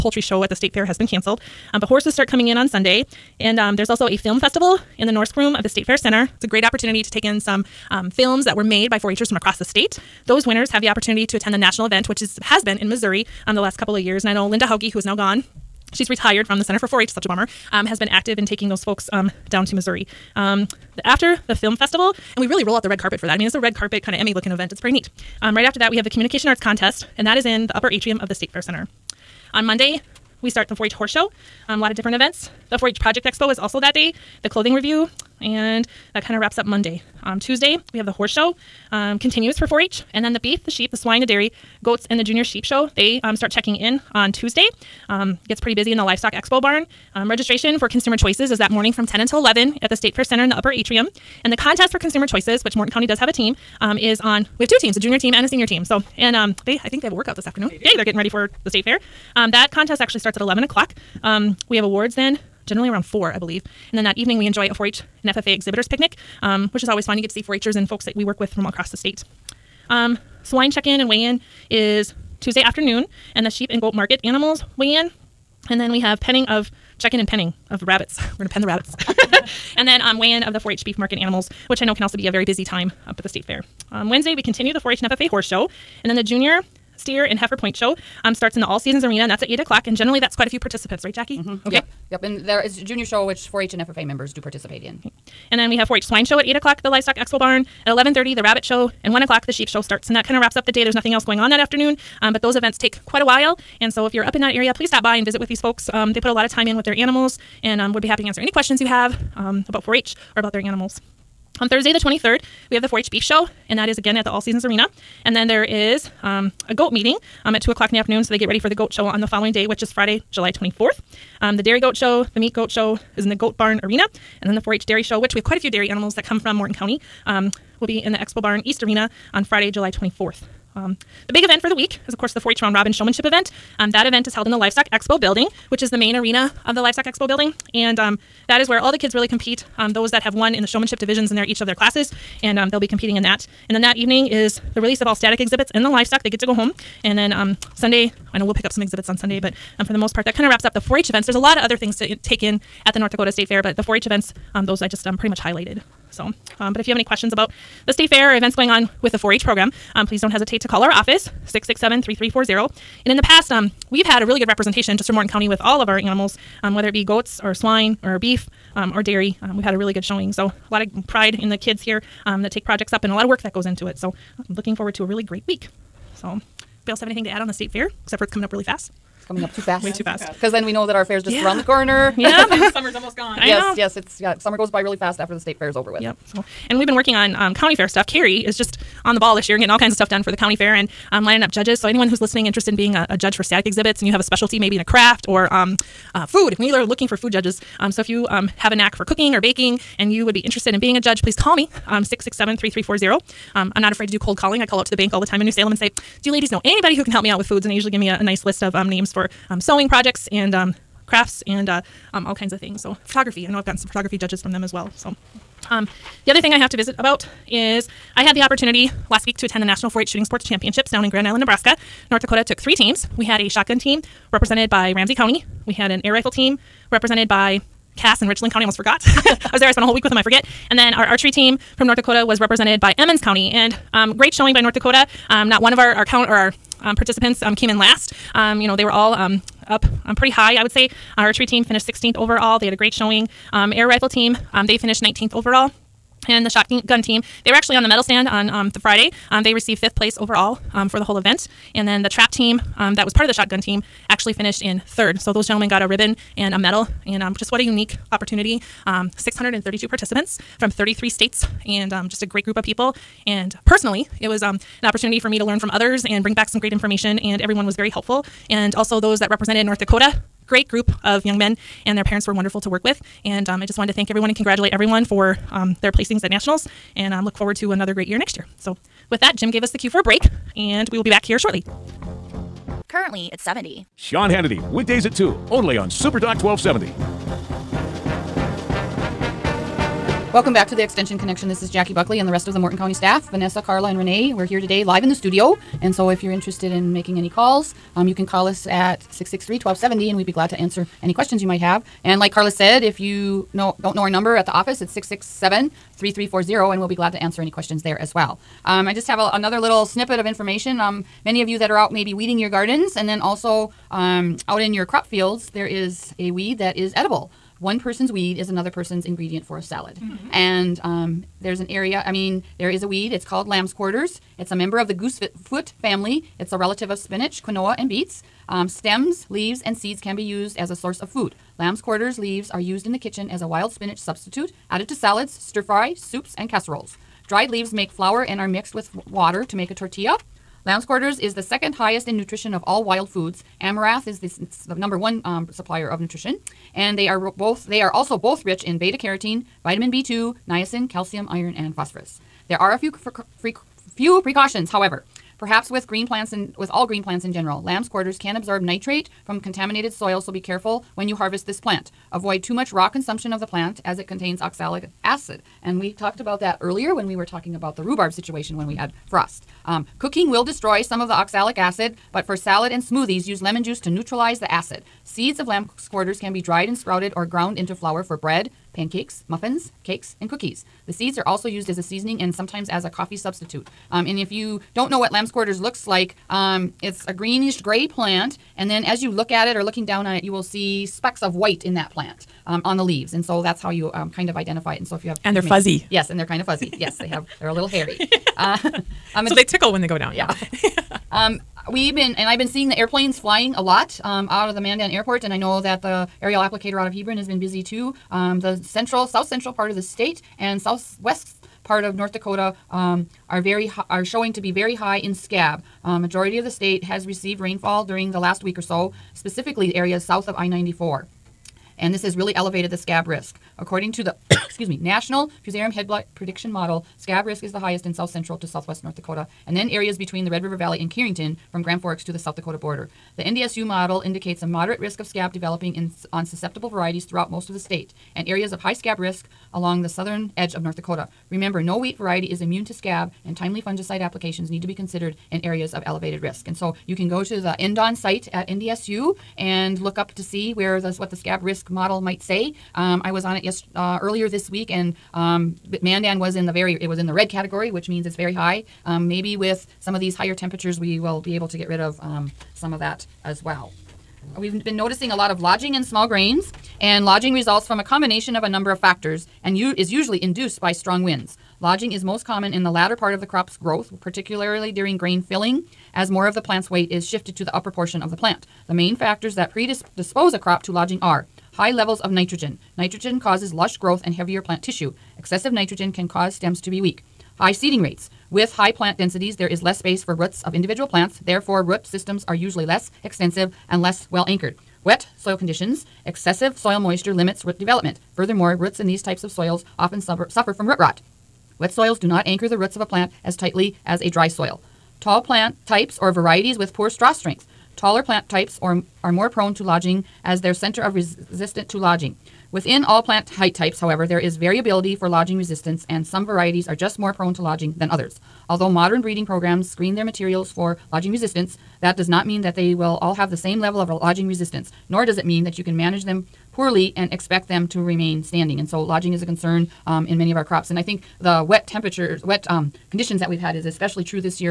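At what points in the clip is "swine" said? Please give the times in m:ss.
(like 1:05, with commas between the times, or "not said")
0:40, 1:10, 1:36, 2:47.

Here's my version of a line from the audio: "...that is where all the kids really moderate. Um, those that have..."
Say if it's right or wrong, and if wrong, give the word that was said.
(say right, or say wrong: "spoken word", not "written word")
wrong: "compete", not "moderate".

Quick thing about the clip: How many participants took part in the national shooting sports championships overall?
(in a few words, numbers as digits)
632.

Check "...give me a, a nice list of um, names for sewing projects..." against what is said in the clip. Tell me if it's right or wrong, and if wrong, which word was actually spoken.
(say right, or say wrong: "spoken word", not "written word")
right.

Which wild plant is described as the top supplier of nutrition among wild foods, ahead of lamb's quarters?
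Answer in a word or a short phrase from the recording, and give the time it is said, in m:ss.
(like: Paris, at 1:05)
Amaranth, at 5:43.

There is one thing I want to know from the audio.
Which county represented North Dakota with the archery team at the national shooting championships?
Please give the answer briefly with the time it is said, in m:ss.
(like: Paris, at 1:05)
Emmons County, at 3:52.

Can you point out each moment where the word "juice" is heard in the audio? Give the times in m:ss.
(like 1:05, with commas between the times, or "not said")
6:13.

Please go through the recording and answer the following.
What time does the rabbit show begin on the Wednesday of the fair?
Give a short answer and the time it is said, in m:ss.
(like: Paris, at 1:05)
11:30, at 1:37.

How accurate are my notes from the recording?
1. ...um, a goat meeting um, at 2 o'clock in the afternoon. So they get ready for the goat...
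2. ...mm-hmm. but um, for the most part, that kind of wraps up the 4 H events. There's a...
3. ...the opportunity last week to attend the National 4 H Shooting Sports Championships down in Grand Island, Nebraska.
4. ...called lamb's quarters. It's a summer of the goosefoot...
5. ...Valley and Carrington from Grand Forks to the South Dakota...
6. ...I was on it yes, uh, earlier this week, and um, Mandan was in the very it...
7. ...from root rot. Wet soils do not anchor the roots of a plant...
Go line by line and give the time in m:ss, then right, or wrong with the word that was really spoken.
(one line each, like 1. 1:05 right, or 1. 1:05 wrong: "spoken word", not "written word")
1. 1:56 right
2. 2:29 right
3. 3:38 right
4. 5:23 wrong: "member", not "summer"
5. 7:10 right
6. 7:33 right
7. 8:20 right.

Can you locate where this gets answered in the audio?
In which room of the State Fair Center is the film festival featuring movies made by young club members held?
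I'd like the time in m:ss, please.
0:05.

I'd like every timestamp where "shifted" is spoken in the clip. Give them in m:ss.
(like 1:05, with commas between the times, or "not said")
7:57.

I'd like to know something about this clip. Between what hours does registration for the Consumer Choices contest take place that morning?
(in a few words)
10 until 11.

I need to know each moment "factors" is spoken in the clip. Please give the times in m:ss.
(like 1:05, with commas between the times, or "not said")
7:48, 7:58.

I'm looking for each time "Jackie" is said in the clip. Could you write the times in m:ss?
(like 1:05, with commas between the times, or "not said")
1:31, 4:51.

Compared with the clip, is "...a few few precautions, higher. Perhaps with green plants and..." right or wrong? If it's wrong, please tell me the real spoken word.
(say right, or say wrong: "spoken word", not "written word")
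wrong: "however", not "higher".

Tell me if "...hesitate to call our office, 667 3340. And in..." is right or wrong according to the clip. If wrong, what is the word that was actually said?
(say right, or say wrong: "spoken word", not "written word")
right.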